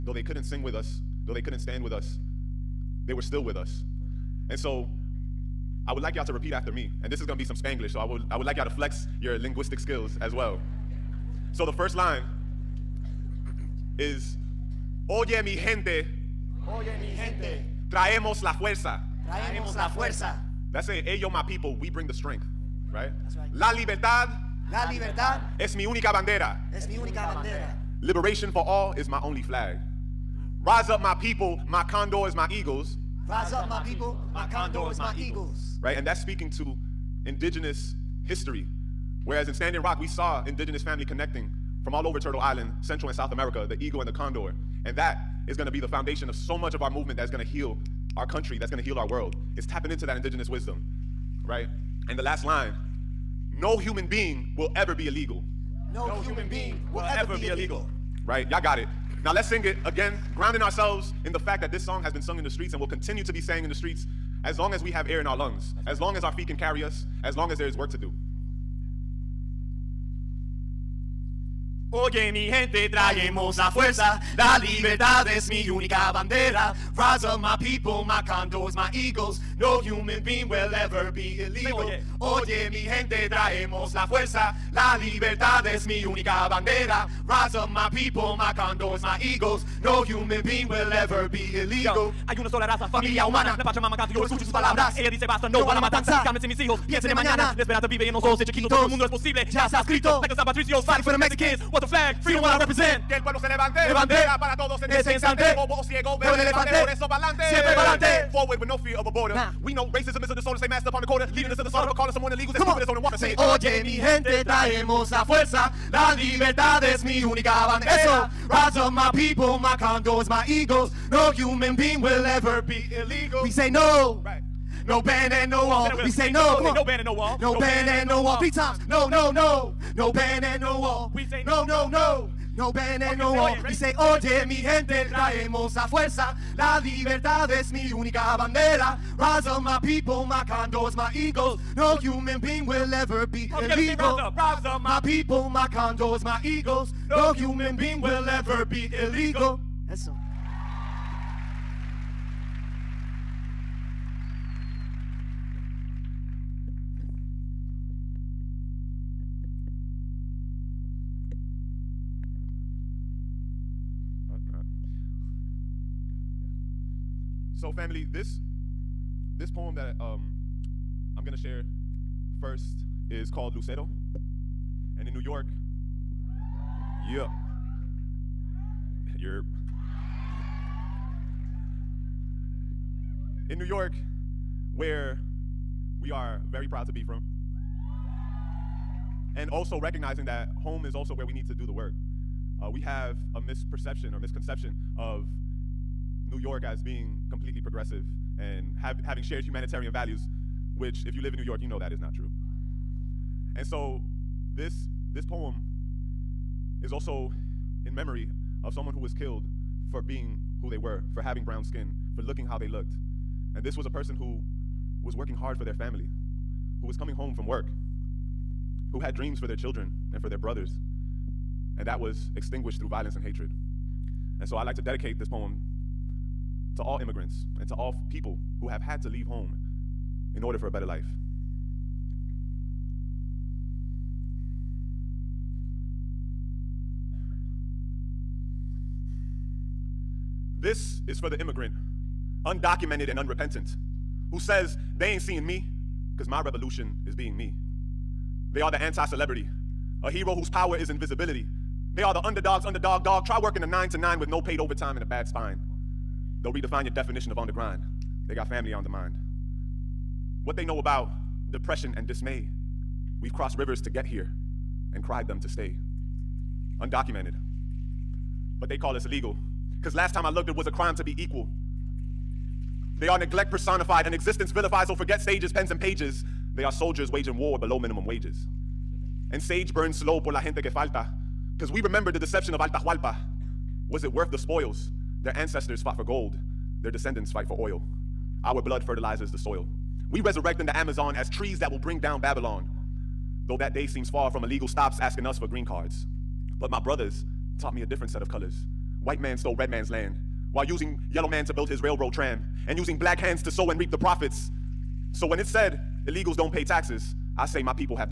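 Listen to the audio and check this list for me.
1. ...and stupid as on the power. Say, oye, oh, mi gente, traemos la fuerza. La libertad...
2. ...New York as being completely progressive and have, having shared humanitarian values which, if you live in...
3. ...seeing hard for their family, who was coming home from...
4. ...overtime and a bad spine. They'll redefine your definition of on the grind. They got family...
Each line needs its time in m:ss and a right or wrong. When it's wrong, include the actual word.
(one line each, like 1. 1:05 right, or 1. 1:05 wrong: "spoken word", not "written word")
1. 1:52 wrong: "water", not "power"
2. 3:16 right
3. 3:35 wrong: "working", not "seeing"
4. 4:14 right.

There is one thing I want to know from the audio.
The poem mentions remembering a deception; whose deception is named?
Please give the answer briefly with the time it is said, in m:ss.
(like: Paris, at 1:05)
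Atahualpa, at 4:42.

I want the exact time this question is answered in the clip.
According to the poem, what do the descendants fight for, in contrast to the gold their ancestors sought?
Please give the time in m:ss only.
4:47.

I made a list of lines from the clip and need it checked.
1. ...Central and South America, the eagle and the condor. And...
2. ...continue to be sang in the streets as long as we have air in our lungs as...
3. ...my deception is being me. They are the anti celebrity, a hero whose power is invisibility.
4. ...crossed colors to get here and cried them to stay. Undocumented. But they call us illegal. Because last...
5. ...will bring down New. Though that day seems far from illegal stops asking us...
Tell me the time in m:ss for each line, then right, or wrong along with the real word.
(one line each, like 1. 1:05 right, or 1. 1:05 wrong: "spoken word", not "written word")
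1. 0:42 right
2. 1:02 right
3. 4:06 wrong: "revolution", not "deception"
4. 4:23 wrong: "rivers", not "colors"
5. 4:51 wrong: "Babylon", not "New".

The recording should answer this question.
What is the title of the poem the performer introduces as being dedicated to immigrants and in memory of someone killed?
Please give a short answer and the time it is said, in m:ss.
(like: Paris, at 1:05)
Lucero, at 2:53.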